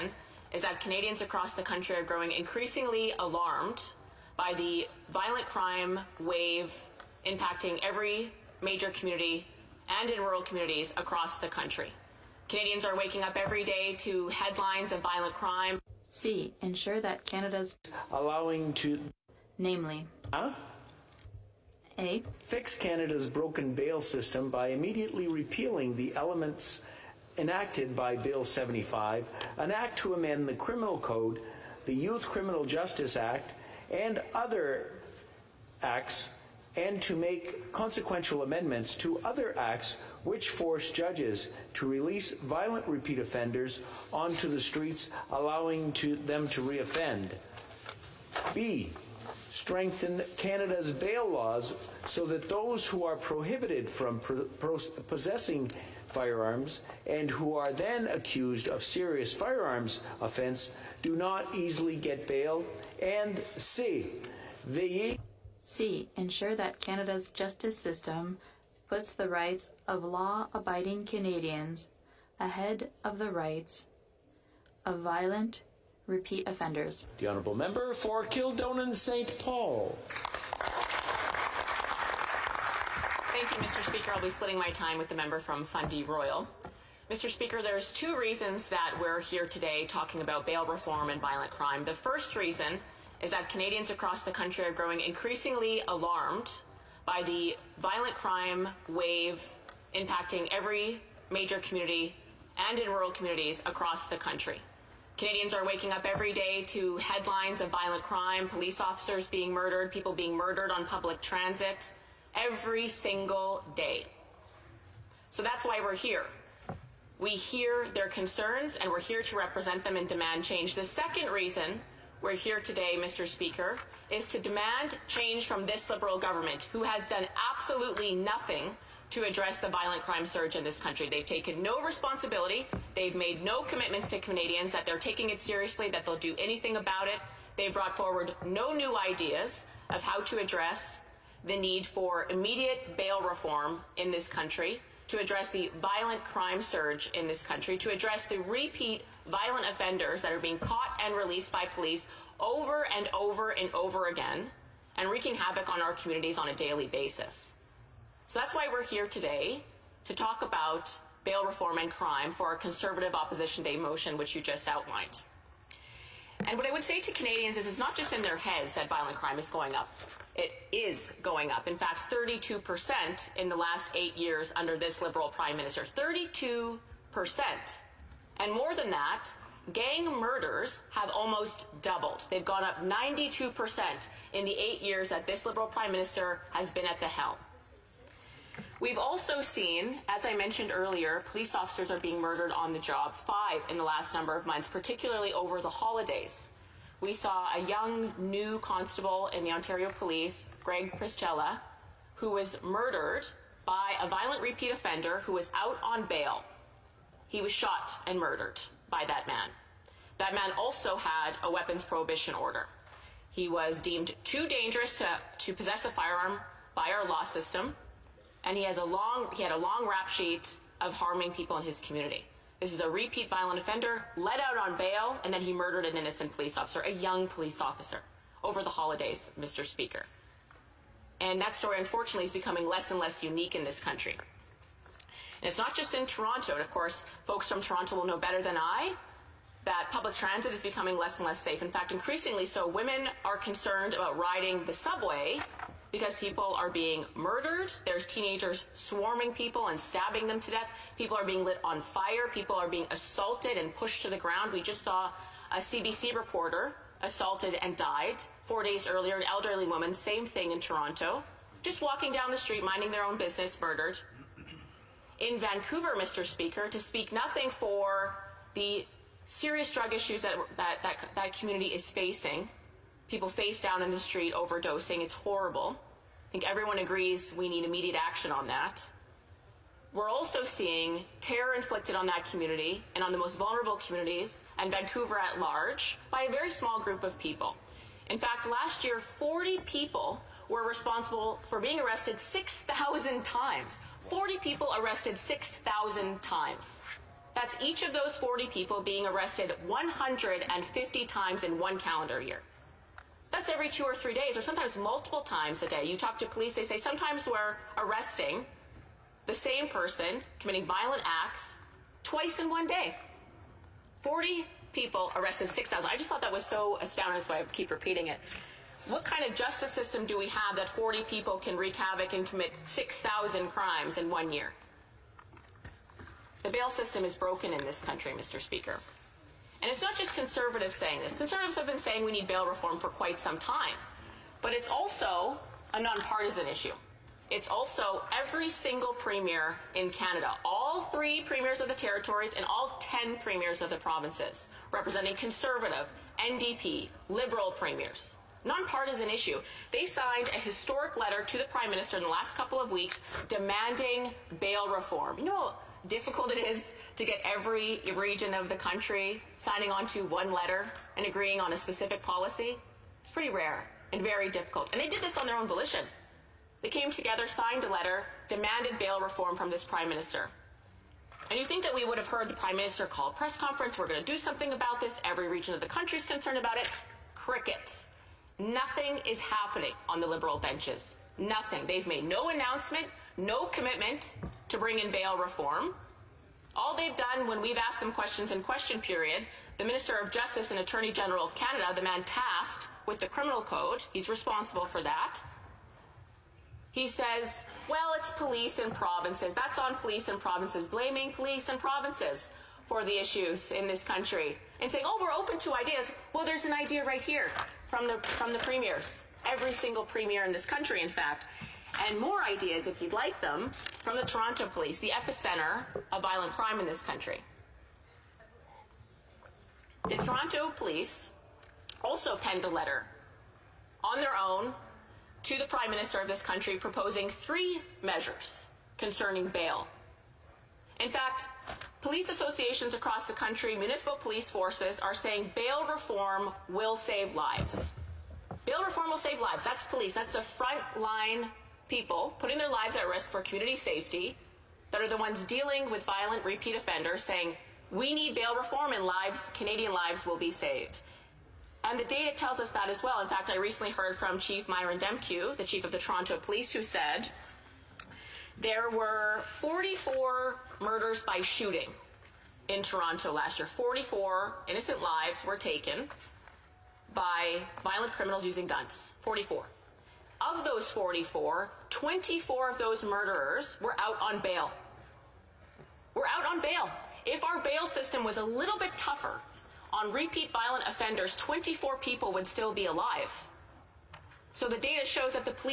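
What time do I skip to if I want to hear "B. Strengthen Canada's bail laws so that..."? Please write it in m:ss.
0:48.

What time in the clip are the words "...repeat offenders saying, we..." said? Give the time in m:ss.
7:26.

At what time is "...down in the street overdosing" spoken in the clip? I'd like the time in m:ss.
4:33.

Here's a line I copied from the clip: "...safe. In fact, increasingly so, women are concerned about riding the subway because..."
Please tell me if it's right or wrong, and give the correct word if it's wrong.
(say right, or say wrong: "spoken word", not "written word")
right.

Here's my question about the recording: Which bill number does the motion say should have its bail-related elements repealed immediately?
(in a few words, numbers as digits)
Bill 75.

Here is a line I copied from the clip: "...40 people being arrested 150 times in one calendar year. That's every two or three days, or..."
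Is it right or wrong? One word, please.
right.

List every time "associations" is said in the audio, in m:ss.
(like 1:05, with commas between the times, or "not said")
7:12.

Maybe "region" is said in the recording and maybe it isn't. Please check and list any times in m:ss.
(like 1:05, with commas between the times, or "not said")
5:57, 6:15.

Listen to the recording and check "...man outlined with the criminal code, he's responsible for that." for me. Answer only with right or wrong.
wrong.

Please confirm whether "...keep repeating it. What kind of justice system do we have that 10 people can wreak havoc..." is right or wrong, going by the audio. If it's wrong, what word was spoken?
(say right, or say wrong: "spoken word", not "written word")
wrong: "40", not "10".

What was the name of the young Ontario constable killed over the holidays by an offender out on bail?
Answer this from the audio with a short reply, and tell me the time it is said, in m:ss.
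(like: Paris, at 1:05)
Greg Pierzchala, at 3:20.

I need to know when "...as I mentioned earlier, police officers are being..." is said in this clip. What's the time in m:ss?
3:10.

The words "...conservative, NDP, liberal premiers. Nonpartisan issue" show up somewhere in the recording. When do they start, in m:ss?
5:45.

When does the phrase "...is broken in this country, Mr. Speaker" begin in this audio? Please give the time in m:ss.
5:27.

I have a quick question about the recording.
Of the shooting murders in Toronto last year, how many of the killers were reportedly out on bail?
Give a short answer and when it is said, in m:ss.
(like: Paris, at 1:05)
24, at 7:51.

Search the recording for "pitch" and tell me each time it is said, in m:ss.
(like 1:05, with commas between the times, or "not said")
not said.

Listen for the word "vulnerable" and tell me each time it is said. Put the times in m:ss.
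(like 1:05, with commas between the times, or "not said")
4:43.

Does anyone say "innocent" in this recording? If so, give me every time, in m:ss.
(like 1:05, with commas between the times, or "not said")
3:45, 7:44.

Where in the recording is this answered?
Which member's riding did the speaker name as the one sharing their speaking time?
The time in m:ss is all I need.
1:25.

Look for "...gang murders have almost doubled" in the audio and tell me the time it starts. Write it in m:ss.
2:59.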